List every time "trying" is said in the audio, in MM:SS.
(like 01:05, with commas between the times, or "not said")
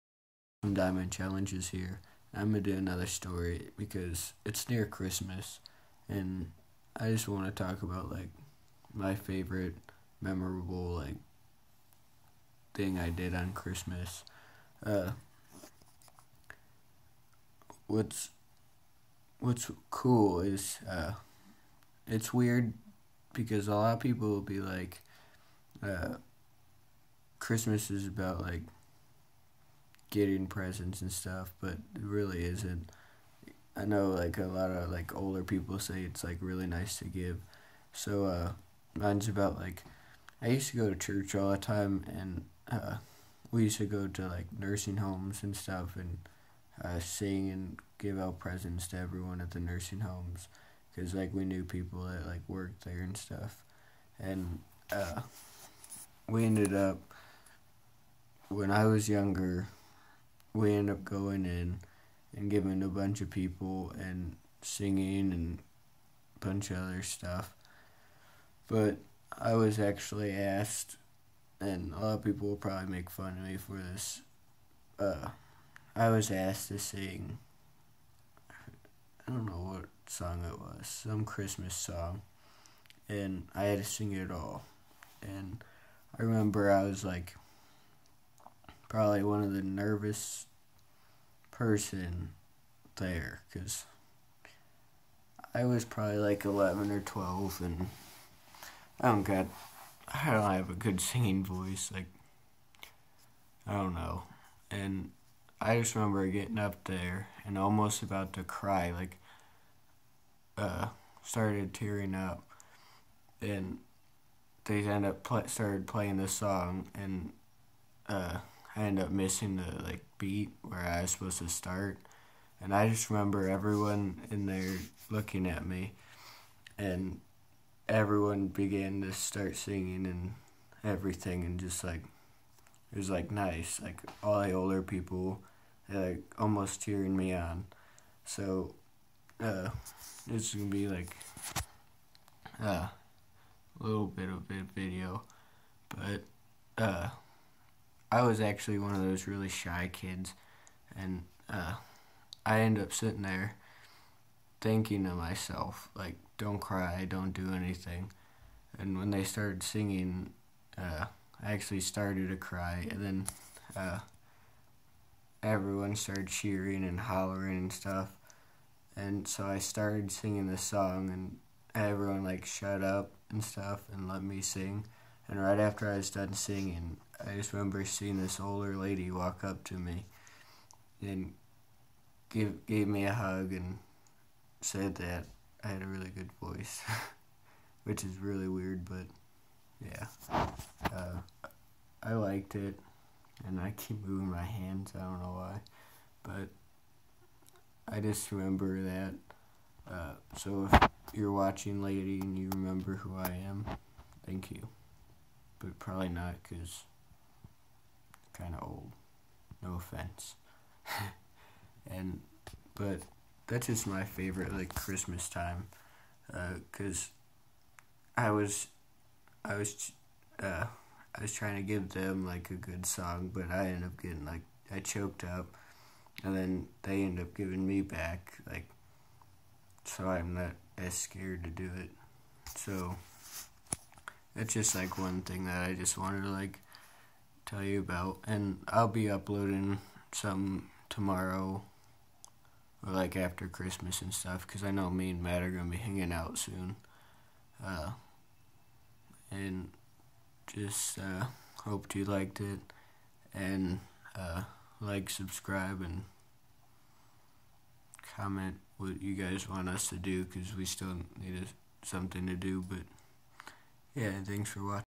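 03:41.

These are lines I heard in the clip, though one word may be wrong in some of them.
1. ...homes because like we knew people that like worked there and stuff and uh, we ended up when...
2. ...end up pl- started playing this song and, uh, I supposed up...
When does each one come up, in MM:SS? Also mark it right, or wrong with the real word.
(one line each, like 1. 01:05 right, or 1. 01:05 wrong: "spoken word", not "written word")
1. 00:50 right
2. 01:54 wrong: "ended", not "supposed".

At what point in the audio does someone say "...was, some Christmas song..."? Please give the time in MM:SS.
01:20.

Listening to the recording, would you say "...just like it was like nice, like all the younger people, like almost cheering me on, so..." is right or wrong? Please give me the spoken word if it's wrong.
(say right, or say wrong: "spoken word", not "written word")
wrong: "older", not "younger".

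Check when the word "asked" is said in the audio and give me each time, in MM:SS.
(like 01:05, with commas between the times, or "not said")
01:10, 01:16.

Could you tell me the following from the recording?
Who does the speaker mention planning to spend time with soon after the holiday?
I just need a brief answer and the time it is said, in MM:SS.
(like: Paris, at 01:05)
Matt, at 04:05.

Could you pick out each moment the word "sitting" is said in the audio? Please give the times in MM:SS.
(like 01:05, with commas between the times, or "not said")
02:32.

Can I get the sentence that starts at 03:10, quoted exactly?
Uh, I liked it, and I keep moving my hands, I don't know why, but I just remember that.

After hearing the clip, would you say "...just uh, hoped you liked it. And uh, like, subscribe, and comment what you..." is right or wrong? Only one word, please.
right.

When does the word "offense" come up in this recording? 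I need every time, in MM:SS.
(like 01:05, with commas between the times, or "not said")
03:29.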